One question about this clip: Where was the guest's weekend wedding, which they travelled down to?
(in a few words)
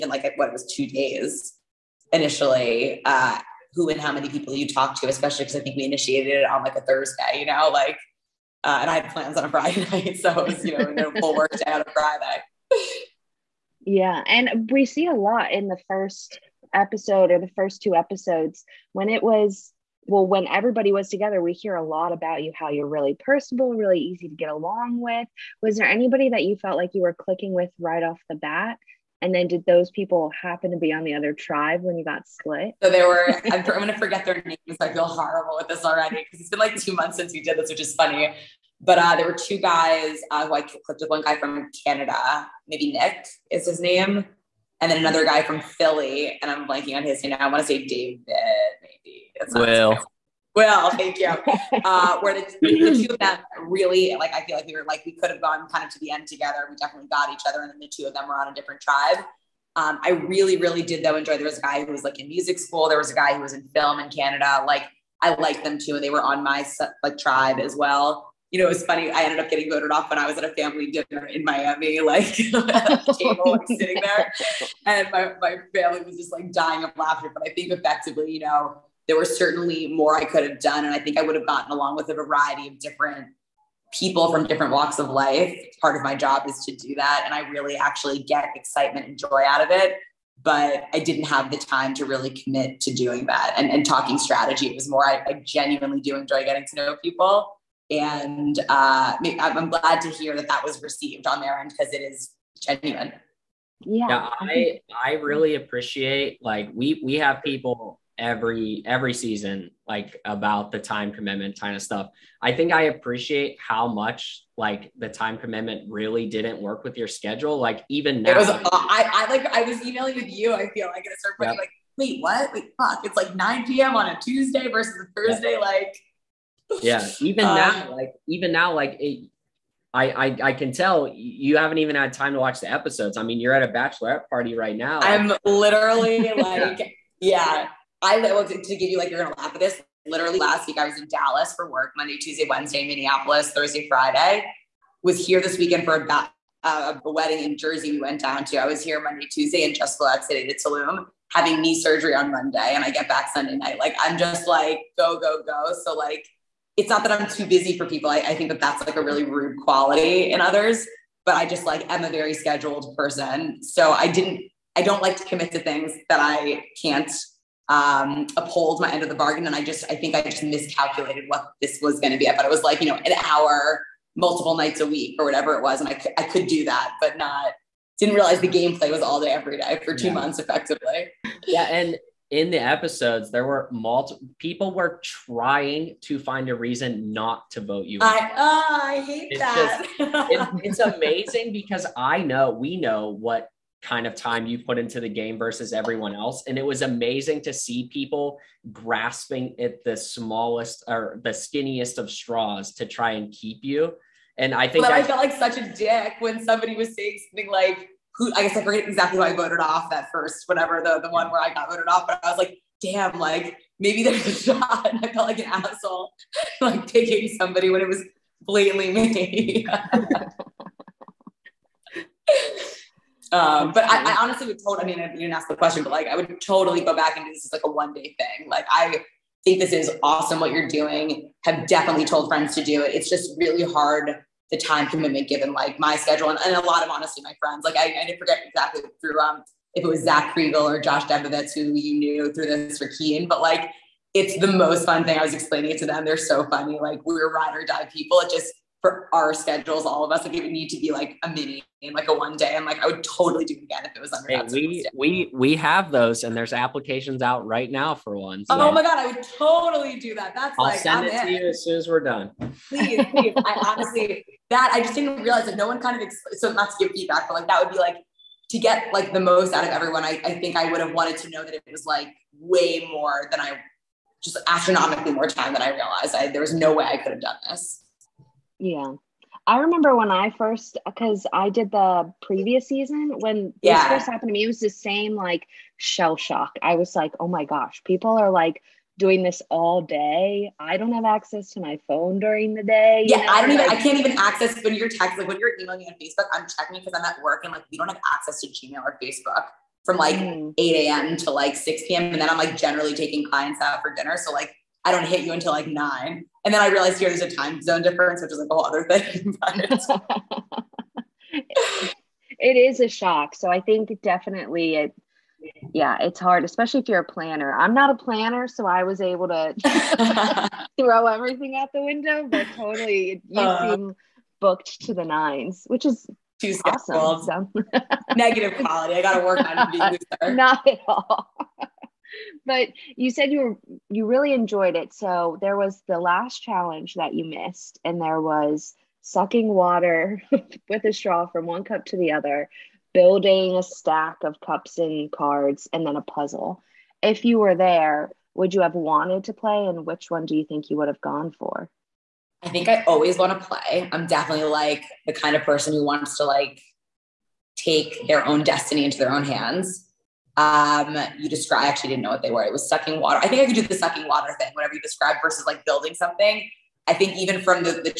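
Jersey.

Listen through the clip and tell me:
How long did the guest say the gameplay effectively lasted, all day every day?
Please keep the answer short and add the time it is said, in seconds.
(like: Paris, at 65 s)
2 months, at 179 s.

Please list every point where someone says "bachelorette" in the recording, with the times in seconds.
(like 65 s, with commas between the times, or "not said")
133 s.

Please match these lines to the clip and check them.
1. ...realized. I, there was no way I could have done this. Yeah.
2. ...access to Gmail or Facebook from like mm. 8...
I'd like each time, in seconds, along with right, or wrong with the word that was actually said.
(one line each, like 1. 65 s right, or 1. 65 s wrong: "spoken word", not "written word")
1. 275 s right
2. 298 s right.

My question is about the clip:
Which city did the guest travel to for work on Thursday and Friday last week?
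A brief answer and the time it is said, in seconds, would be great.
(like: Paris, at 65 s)
Minneapolis, at 142 s.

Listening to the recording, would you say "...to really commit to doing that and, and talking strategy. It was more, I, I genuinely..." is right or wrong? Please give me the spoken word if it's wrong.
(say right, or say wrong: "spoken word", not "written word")
right.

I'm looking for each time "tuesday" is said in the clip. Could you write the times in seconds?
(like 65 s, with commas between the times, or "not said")
124 s, 142 s, 149 s.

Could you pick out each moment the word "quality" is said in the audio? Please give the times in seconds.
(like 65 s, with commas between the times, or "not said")
159 s, 328 s.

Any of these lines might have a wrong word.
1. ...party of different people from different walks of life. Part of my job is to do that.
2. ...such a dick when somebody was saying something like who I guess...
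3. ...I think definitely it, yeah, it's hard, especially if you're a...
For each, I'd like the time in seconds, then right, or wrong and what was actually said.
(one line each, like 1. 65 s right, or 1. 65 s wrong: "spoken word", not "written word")
1. 82 s wrong: "variety", not "party"
2. 205 s right
3. 313 s right.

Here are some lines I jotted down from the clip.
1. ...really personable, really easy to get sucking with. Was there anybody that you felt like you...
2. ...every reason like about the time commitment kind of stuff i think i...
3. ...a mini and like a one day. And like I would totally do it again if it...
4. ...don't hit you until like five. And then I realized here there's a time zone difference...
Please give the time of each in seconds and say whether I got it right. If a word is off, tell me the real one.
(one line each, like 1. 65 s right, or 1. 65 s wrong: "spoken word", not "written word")
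1. 22 s wrong: "along", not "sucking"
2. 108 s wrong: "season", not "reason"
3. 251 s right
4. 304 s wrong: "nine", not "five".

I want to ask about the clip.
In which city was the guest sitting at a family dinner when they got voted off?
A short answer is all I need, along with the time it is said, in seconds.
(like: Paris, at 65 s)
Miami, at 71 s.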